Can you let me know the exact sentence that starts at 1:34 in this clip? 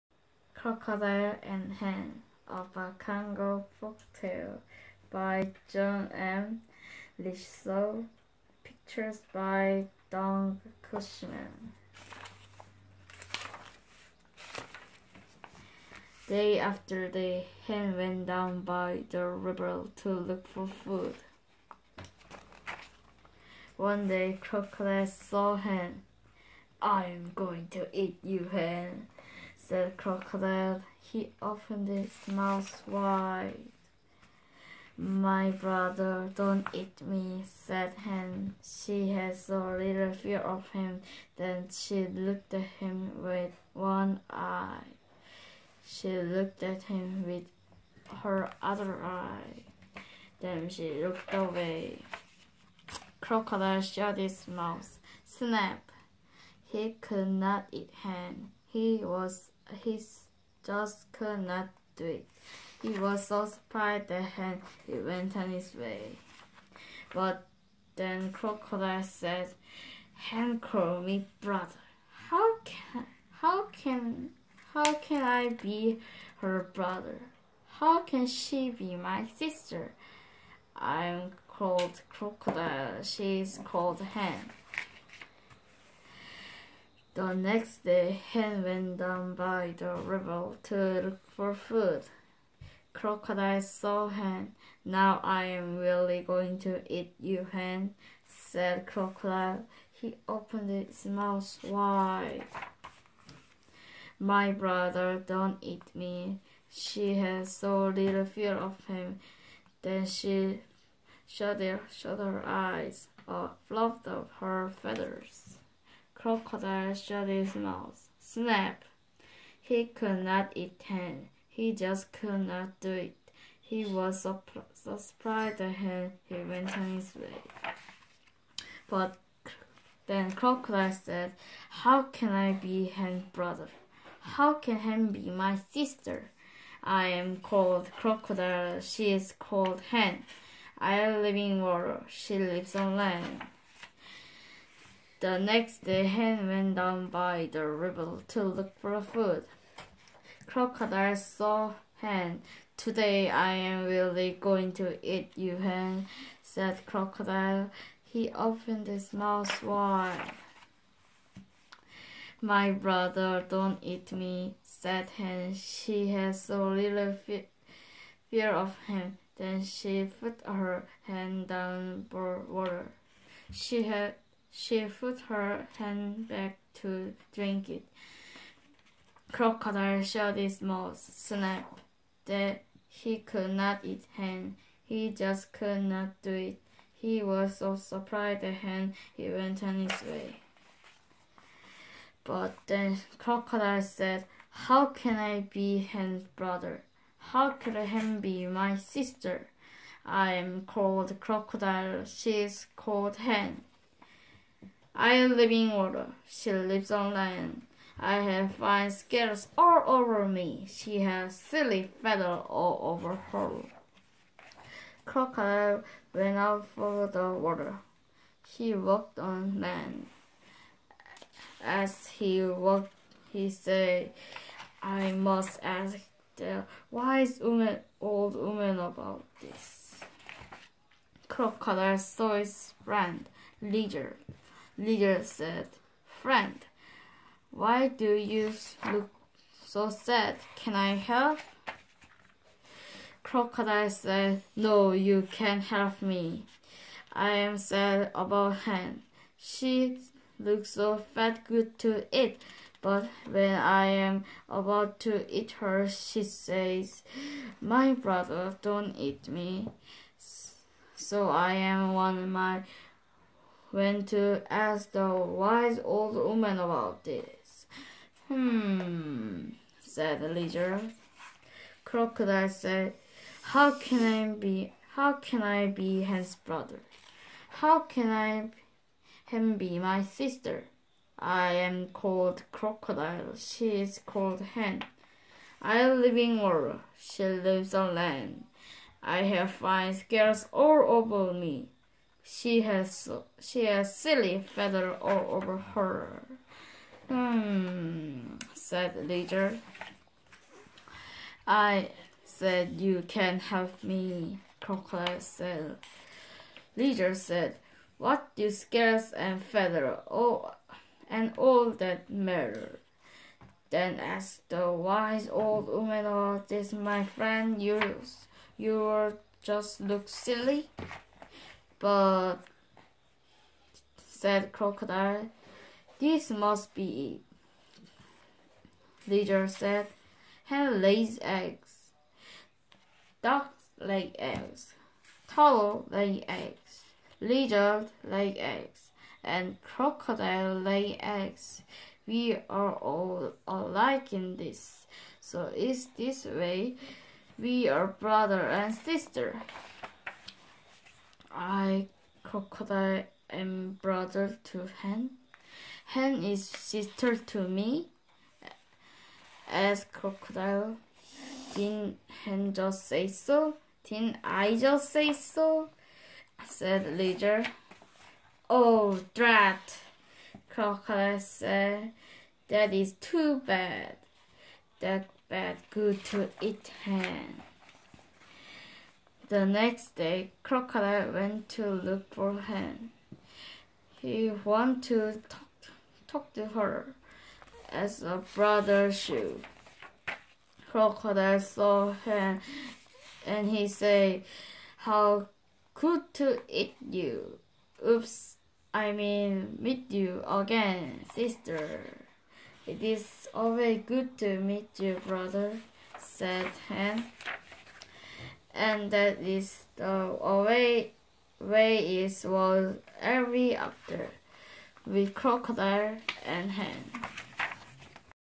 Now I am really going to eat you, Hen, said Crocodile.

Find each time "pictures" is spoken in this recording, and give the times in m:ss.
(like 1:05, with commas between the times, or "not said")
0:08.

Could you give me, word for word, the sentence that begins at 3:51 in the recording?
Crocodile saw his friend, leader leader said, Friend, why do you look so sad?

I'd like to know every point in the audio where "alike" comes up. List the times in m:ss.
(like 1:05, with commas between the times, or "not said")
5:43.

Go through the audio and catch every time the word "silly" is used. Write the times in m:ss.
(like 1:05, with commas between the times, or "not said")
3:31, 4:53, 5:20.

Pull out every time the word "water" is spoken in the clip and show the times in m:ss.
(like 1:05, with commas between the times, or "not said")
2:21, 2:52, 3:25, 3:37, 4:46.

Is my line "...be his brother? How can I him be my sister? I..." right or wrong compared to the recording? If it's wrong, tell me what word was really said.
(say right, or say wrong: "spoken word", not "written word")
right.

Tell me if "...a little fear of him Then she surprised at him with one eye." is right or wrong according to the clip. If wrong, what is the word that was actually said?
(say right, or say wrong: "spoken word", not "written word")
wrong: "looked", not "surprised".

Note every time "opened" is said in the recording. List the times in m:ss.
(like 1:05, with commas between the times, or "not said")
0:31, 1:40, 2:38.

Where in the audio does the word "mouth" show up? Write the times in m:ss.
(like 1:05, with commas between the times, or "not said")
0:32, 0:54, 1:41, 1:57, 2:39, 3:00.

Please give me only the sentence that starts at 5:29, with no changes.
Leader said, hen lays eggs, ducks lay eggs, turtle lay eggs, lizard lay eggs, and crocodile lay eggs.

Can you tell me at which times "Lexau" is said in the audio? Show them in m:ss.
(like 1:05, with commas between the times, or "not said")
0:07.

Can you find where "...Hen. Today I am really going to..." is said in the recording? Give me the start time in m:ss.
2:31.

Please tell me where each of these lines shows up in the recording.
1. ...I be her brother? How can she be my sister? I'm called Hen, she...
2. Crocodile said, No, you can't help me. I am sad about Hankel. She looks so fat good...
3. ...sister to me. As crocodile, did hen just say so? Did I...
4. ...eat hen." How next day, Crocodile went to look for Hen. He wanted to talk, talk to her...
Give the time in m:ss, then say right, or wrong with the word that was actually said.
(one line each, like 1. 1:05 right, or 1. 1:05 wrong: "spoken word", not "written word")
1. 1:15 wrong: "Crocodile", not "Hen"
2. 4:03 wrong: "Hen", not "Hankel"
3. 5:56 right
4. 6:16 wrong: "The", not "How".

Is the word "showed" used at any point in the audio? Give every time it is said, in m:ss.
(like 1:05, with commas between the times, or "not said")
3:00.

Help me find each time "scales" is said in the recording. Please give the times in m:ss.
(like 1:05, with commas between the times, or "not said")
3:28, 4:49, 5:08.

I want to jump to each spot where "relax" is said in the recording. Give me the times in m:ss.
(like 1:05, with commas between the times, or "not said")
not said.